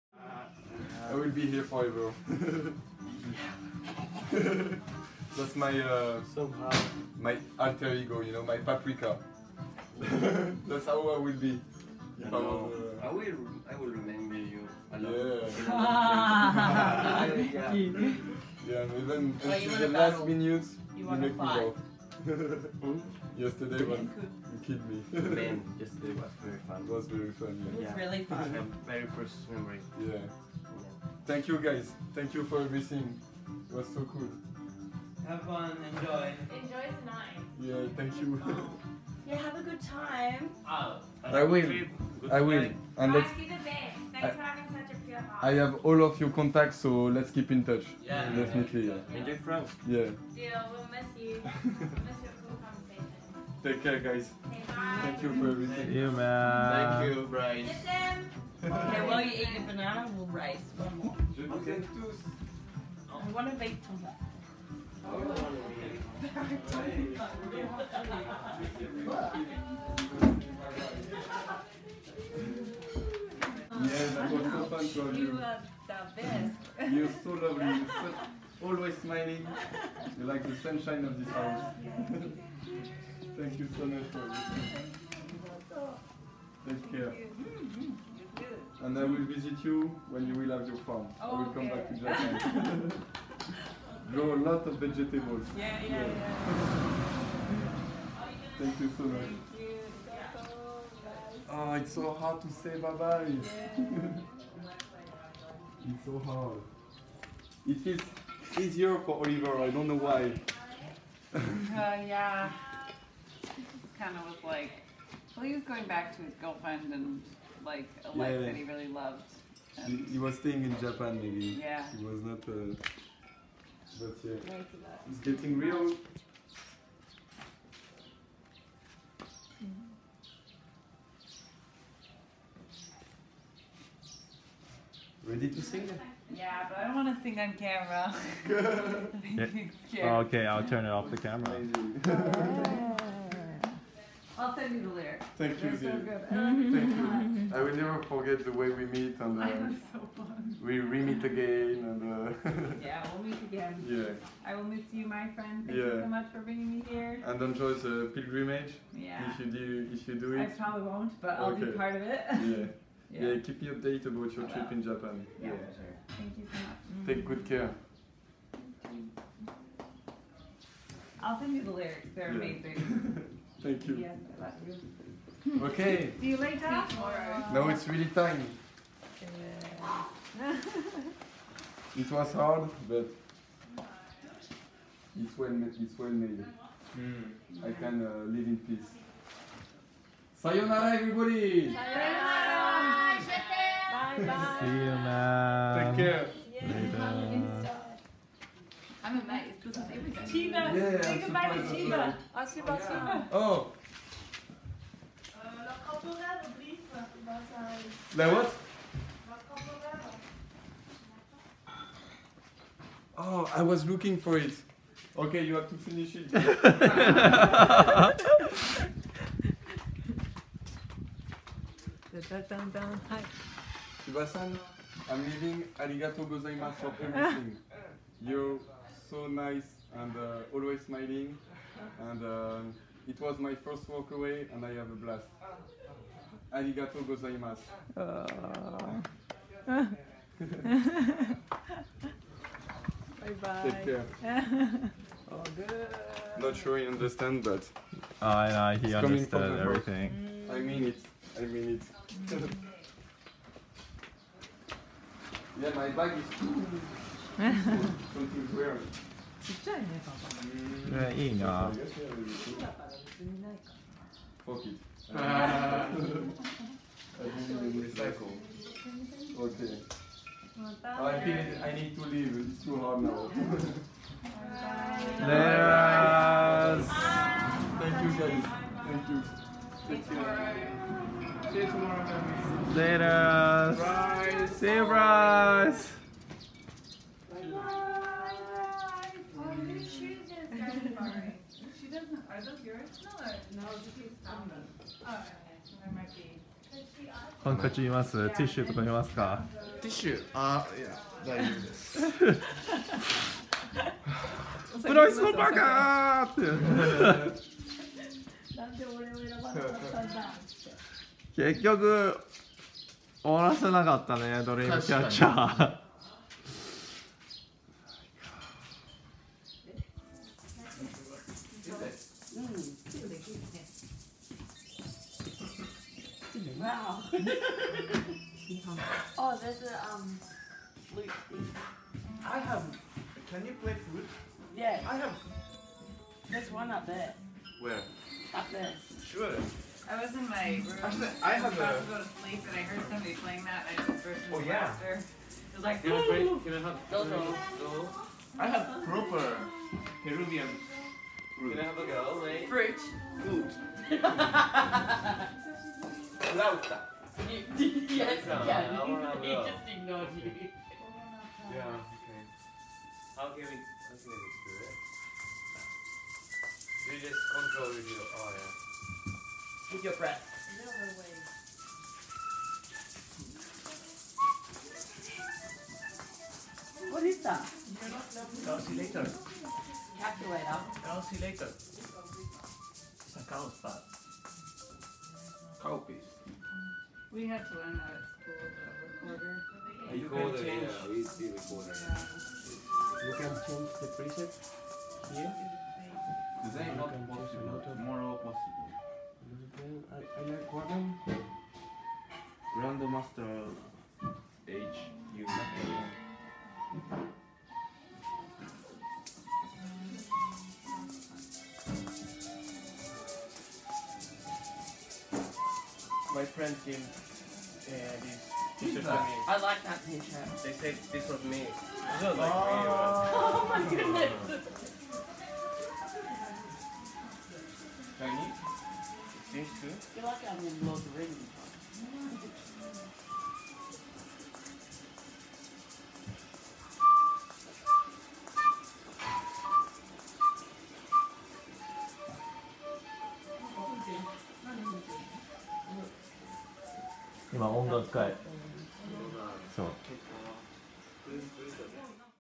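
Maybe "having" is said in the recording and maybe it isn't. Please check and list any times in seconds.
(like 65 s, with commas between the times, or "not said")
44 s.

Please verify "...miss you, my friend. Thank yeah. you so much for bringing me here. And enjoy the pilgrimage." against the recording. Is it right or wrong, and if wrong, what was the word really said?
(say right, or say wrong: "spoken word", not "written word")
right.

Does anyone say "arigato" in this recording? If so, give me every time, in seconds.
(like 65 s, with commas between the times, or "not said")
225 s, 236 s.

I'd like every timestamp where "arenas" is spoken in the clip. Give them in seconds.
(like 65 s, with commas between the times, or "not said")
not said.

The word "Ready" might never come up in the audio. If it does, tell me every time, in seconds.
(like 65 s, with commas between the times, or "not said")
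135 s.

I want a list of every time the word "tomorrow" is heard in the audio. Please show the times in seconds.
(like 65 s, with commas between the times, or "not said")
176 s, 282 s, 397 s.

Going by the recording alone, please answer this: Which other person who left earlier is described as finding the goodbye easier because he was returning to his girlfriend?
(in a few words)
Oliver.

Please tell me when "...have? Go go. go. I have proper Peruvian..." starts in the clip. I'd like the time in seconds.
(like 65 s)
346 s.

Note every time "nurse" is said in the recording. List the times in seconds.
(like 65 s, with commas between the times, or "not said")
not said.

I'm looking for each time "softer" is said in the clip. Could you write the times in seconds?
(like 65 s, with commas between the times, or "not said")
not said.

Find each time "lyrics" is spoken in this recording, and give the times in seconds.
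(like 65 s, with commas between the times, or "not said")
144 s, 171 s.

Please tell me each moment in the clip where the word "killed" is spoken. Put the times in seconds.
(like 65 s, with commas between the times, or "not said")
24 s.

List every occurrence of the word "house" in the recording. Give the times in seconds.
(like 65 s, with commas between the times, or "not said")
81 s.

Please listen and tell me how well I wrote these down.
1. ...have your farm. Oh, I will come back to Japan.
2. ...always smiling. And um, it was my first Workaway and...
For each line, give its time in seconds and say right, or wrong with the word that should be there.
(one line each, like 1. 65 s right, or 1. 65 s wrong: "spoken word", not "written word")
1. 90 s right
2. 230 s right.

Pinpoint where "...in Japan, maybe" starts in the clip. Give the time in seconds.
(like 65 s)
120 s.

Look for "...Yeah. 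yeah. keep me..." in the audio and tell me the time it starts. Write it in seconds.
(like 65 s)
163 s.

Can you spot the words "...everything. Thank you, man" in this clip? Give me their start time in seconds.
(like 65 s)
55 s.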